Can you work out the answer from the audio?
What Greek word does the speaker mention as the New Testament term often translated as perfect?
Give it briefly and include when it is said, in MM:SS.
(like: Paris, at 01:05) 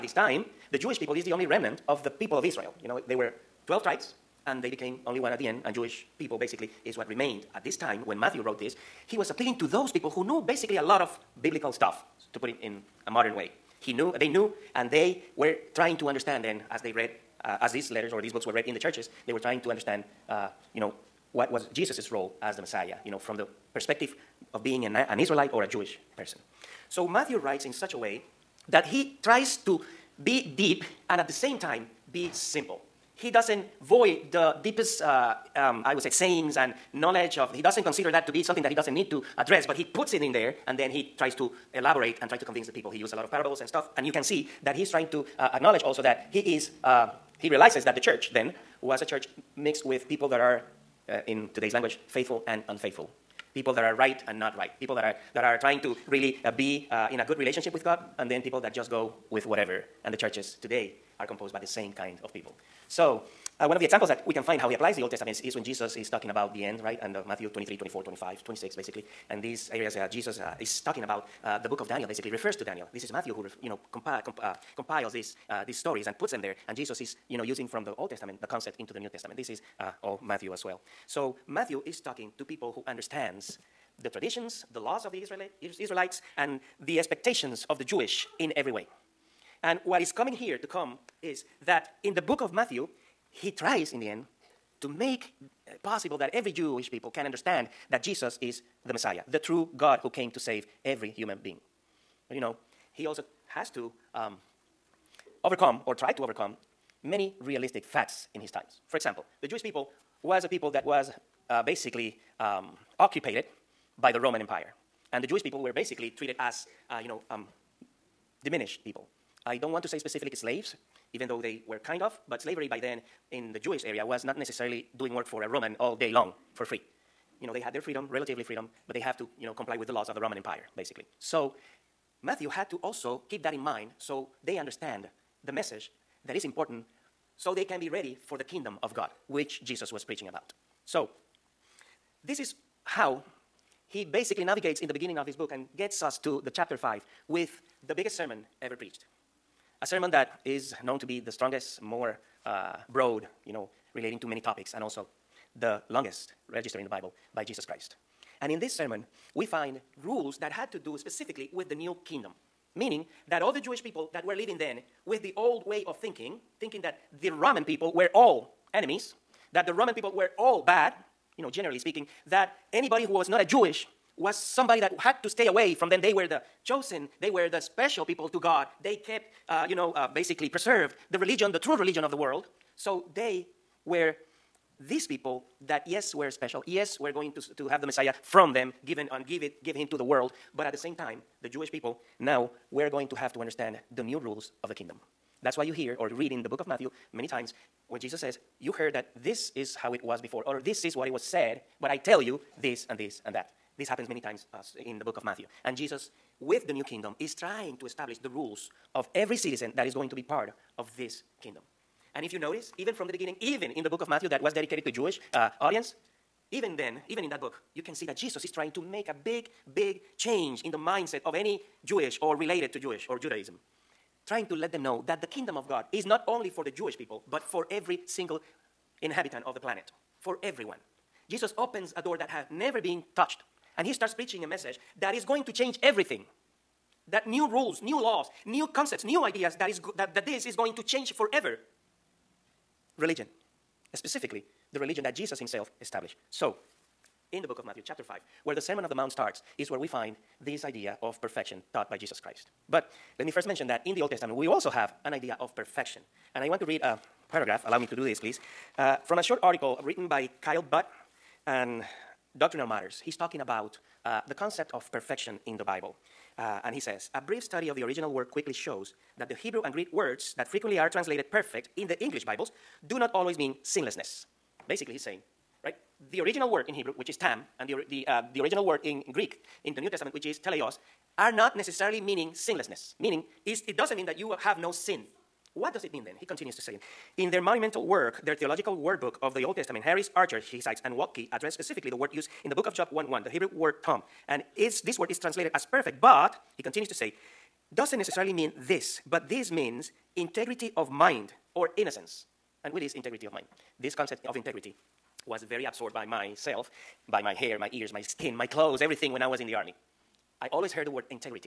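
teleos, at 04:40.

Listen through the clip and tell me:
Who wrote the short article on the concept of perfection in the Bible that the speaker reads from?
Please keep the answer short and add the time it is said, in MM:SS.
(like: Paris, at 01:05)
Kyle Butt, at 04:20.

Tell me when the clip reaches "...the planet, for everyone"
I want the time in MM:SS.
03:49.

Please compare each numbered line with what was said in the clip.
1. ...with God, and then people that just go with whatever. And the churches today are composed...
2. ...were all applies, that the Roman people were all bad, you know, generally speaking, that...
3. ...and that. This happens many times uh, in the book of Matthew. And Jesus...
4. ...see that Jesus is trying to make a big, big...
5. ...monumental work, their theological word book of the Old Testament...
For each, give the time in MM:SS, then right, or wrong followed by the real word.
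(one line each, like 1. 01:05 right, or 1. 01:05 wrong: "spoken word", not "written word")
1. 00:57 right
2. 02:47 wrong: "enemies", not "applies"
3. 03:23 right
4. 03:37 right
5. 04:47 right.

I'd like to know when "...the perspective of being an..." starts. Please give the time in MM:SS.
00:23.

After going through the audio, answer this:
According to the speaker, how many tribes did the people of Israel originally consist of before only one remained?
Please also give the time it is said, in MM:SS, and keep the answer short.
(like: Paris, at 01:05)
12, at 00:03.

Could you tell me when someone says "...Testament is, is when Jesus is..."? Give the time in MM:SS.
01:05.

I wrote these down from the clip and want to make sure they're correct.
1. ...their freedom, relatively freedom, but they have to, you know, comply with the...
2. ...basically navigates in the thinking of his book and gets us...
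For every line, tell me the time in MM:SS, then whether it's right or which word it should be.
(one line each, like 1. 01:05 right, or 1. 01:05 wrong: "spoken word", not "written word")
1. 02:07 right
2. 02:24 wrong: "beginning", not "thinking".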